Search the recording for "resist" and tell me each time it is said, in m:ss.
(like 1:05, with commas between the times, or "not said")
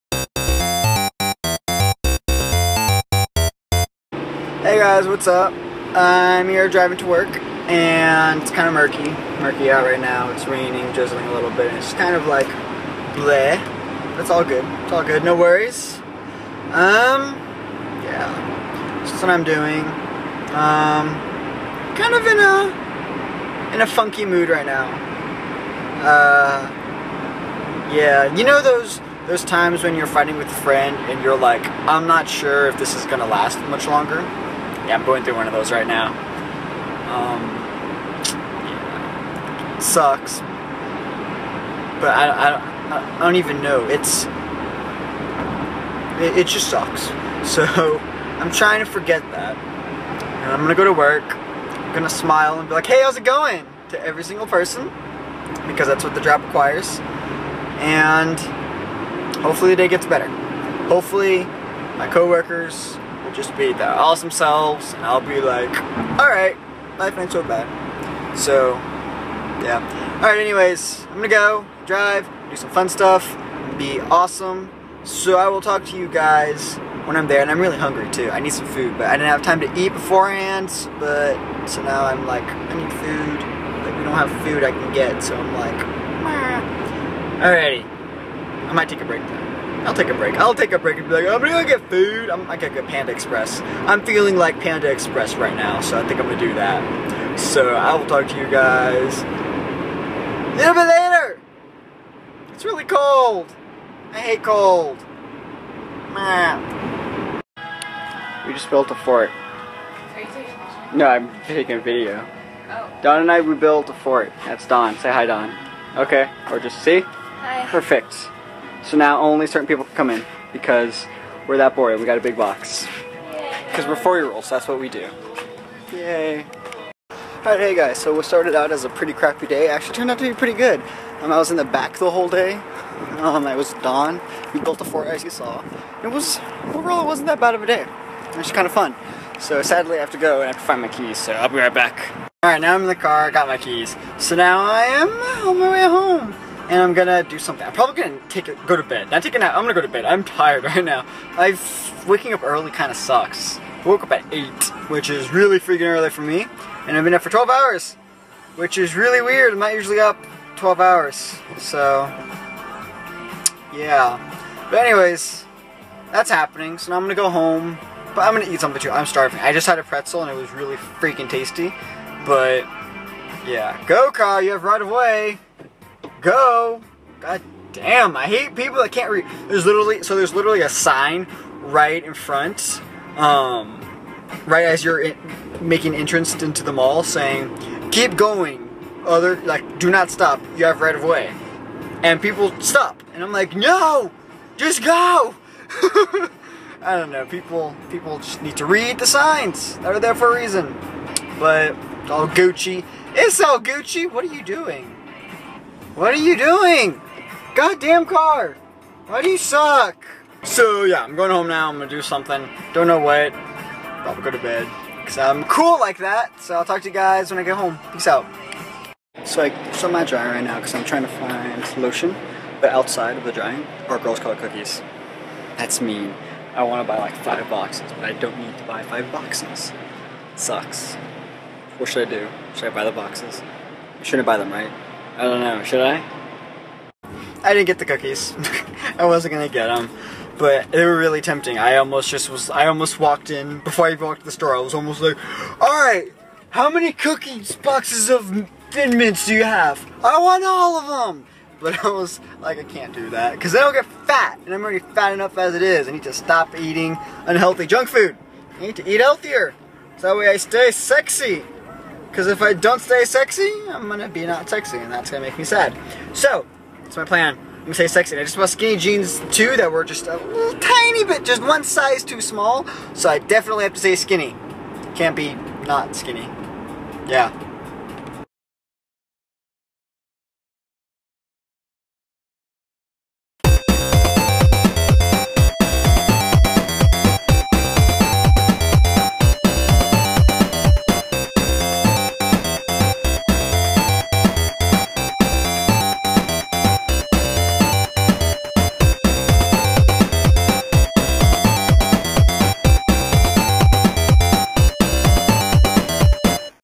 not said.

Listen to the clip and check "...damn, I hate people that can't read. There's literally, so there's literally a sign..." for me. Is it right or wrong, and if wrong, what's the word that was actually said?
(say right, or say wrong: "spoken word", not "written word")
right.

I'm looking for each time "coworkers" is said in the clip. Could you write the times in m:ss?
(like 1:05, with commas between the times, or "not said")
1:02.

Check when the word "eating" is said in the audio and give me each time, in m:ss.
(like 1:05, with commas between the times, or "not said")
4:16.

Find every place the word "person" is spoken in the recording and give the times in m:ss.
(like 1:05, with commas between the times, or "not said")
0:54.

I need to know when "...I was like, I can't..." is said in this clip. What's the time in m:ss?
4:11.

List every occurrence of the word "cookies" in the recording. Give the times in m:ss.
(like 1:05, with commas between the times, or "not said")
3:44, 3:57, 4:06.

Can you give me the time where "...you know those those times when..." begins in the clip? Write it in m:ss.
0:28.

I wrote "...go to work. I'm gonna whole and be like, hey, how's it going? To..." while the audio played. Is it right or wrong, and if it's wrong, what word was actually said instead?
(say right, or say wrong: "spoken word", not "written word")
wrong: "smile", not "whole".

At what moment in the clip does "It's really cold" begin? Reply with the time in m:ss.
1:42.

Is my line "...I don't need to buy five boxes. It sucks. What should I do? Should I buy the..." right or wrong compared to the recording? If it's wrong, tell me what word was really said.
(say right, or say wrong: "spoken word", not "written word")
right.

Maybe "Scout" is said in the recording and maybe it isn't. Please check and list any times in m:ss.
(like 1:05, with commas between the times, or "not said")
3:44.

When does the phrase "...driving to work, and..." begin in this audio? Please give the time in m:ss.
0:06.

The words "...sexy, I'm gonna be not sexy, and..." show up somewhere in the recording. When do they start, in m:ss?
4:23.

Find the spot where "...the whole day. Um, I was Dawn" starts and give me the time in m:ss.
2:11.